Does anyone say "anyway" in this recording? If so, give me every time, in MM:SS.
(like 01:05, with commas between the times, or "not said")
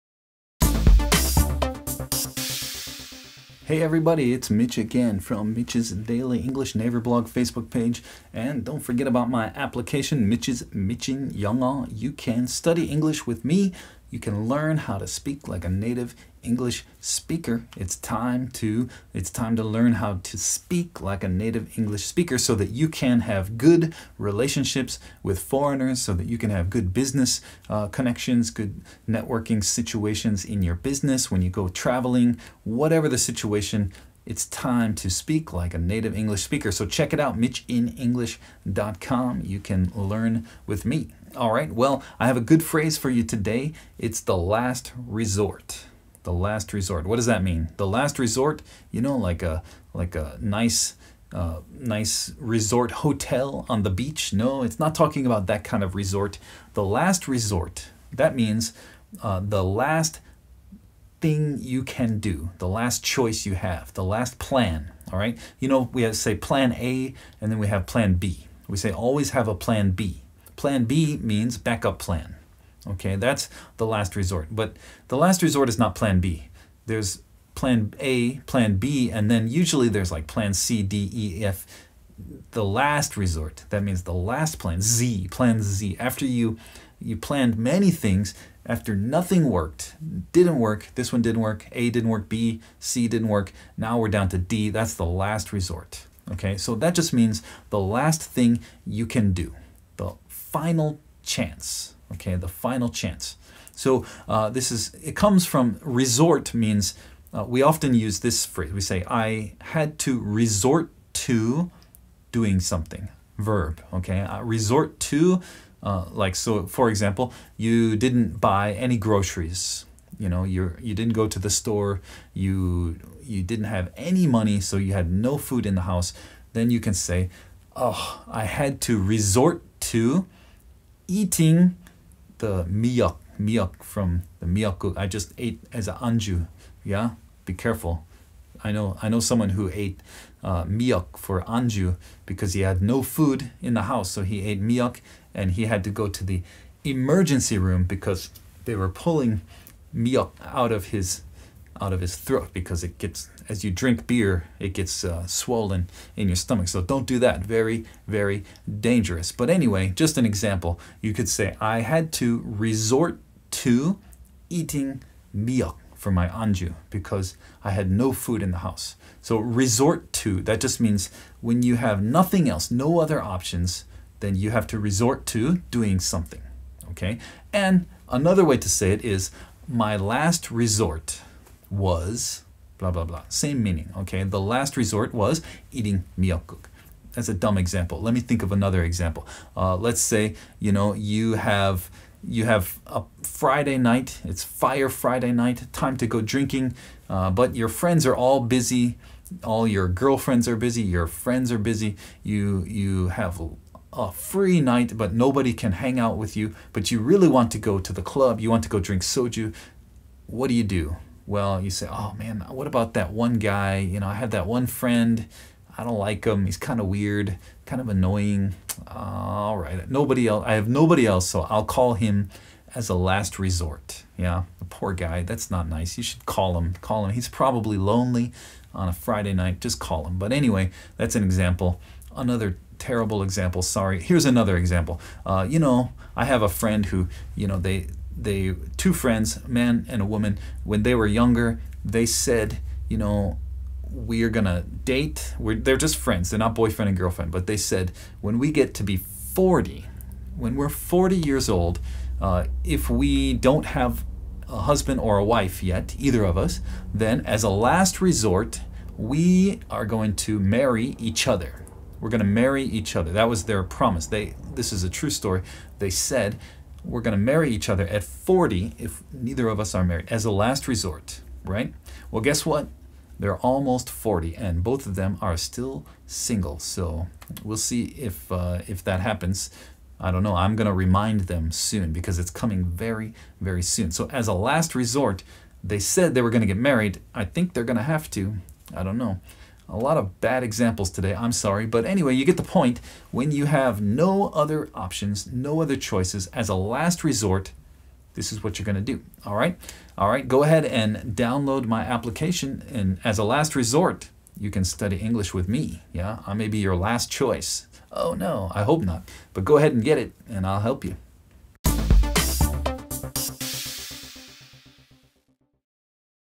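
02:39, 03:50, 04:51.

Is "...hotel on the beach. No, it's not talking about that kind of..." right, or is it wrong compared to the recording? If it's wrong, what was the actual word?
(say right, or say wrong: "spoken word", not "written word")
right.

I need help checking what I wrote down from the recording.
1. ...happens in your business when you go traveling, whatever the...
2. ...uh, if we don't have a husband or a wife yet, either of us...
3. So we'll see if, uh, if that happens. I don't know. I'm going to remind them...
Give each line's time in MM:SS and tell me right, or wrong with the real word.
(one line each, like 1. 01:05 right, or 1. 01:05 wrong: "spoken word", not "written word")
1. 00:29 wrong: "situations", not "happens"
2. 04:12 right
3. 04:36 right.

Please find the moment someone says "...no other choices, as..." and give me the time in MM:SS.
04:55.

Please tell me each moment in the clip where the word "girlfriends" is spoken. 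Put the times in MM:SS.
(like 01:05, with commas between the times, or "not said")
03:19, 04:06.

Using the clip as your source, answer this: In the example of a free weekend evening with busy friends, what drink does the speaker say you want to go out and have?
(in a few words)
soju.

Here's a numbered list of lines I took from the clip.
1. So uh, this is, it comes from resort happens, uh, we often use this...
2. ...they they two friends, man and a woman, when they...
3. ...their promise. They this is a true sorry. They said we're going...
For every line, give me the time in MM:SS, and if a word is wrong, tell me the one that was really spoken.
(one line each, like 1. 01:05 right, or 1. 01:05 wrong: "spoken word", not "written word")
1. 01:43 wrong: "means", not "happens"
2. 03:57 right
3. 04:23 wrong: "story", not "sorry".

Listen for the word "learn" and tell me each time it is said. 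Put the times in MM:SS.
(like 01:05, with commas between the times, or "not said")
00:14, 00:19, 00:39.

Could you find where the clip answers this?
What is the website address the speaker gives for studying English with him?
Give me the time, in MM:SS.
00:37.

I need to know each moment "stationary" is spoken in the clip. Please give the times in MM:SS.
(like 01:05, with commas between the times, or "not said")
not said.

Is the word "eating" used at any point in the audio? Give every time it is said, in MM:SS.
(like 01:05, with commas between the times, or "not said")
02:11, 02:44, 03:05.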